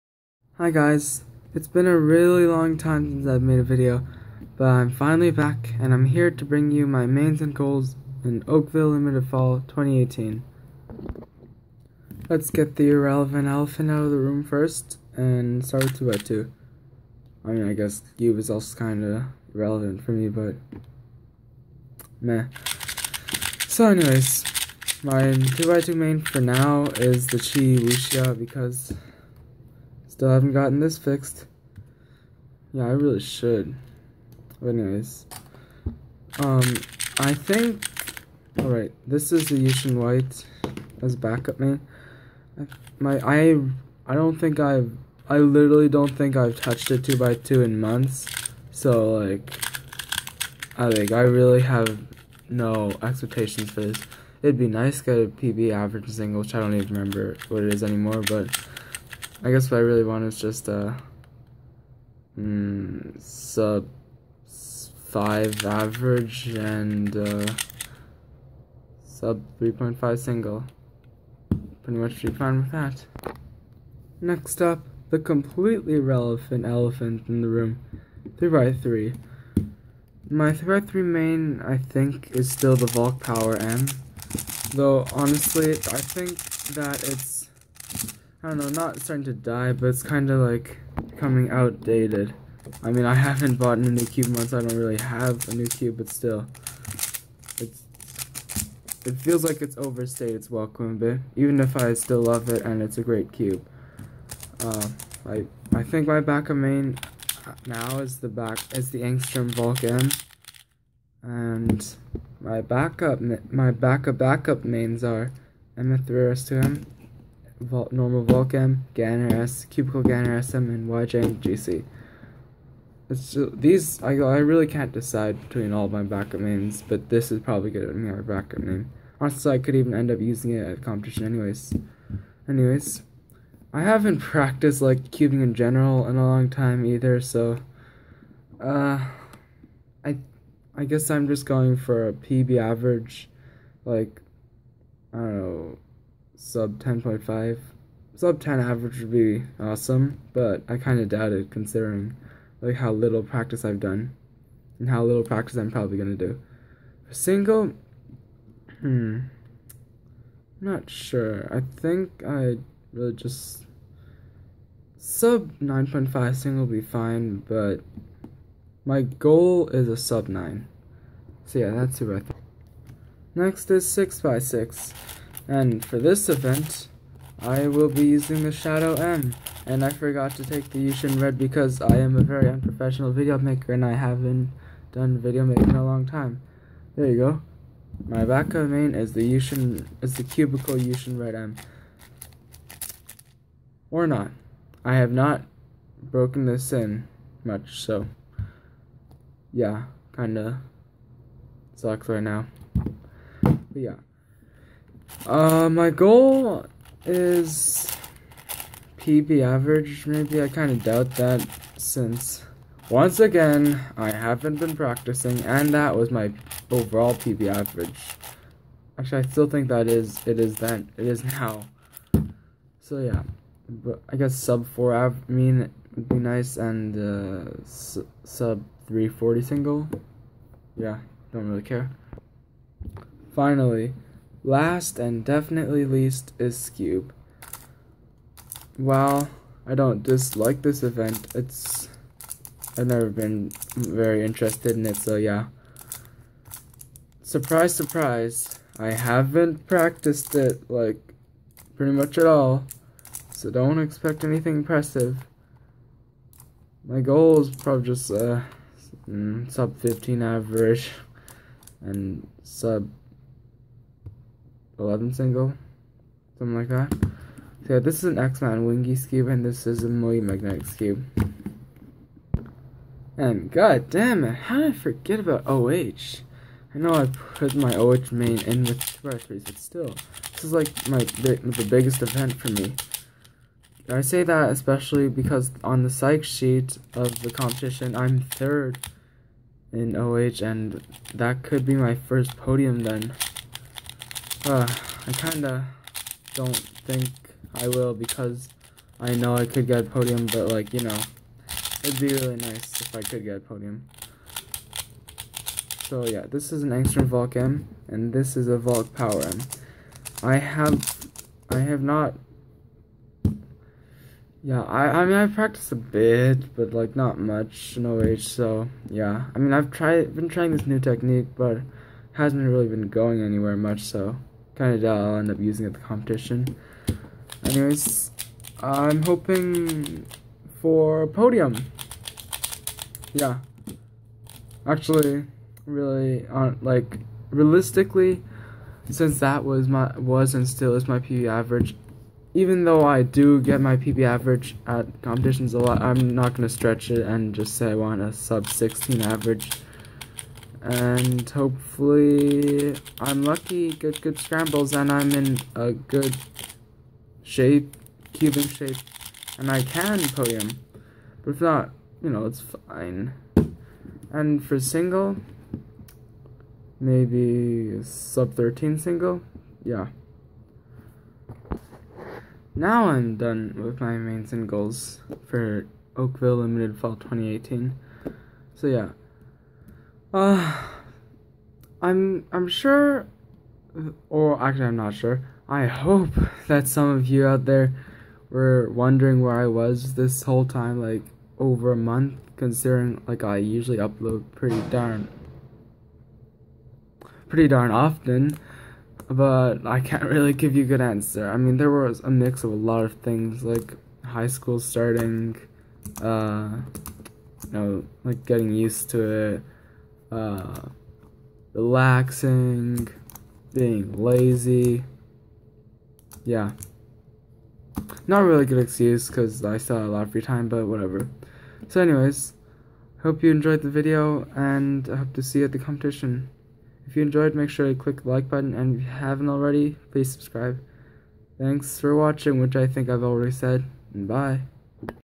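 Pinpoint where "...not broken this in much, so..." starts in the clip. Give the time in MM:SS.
03:15.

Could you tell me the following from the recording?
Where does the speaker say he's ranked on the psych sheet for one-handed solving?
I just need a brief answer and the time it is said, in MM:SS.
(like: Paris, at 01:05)
third, at 04:48.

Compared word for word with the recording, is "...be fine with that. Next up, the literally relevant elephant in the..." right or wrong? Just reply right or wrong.
wrong.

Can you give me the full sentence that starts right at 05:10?
I have, I have not, yeah, I, I mean, I practiced a bit, but like not much, no age, so yeah.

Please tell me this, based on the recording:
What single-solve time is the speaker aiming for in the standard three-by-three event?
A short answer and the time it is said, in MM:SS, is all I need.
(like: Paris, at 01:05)
sub 9, at 02:49.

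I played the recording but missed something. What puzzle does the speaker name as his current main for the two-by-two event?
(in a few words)
Chi Wuxia.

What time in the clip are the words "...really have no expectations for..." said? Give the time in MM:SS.
00:51.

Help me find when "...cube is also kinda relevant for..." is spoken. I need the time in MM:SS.
00:18.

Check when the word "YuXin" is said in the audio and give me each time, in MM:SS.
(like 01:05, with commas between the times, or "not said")
00:39, 03:00, 03:09.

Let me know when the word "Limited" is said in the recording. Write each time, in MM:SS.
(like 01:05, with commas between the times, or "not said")
00:08, 06:16.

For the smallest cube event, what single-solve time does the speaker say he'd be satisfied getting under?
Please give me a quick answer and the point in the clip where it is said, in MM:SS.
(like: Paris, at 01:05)
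3.5, at 01:09.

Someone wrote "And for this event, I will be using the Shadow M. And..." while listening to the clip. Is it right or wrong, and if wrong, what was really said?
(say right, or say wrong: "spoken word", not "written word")
right.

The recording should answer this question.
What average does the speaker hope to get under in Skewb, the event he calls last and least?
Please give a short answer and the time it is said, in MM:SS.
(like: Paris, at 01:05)
sub 15, at 04:19.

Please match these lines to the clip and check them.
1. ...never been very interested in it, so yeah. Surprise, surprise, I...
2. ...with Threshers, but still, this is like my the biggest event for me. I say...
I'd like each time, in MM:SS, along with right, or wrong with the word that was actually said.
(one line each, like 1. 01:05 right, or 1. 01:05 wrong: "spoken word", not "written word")
1. 04:02 right
2. 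04:38 right.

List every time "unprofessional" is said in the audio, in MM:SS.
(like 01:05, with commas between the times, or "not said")
03:02.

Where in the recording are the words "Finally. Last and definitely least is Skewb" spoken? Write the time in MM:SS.
03:53.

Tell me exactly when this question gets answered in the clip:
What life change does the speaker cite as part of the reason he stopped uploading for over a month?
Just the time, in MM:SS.
06:44.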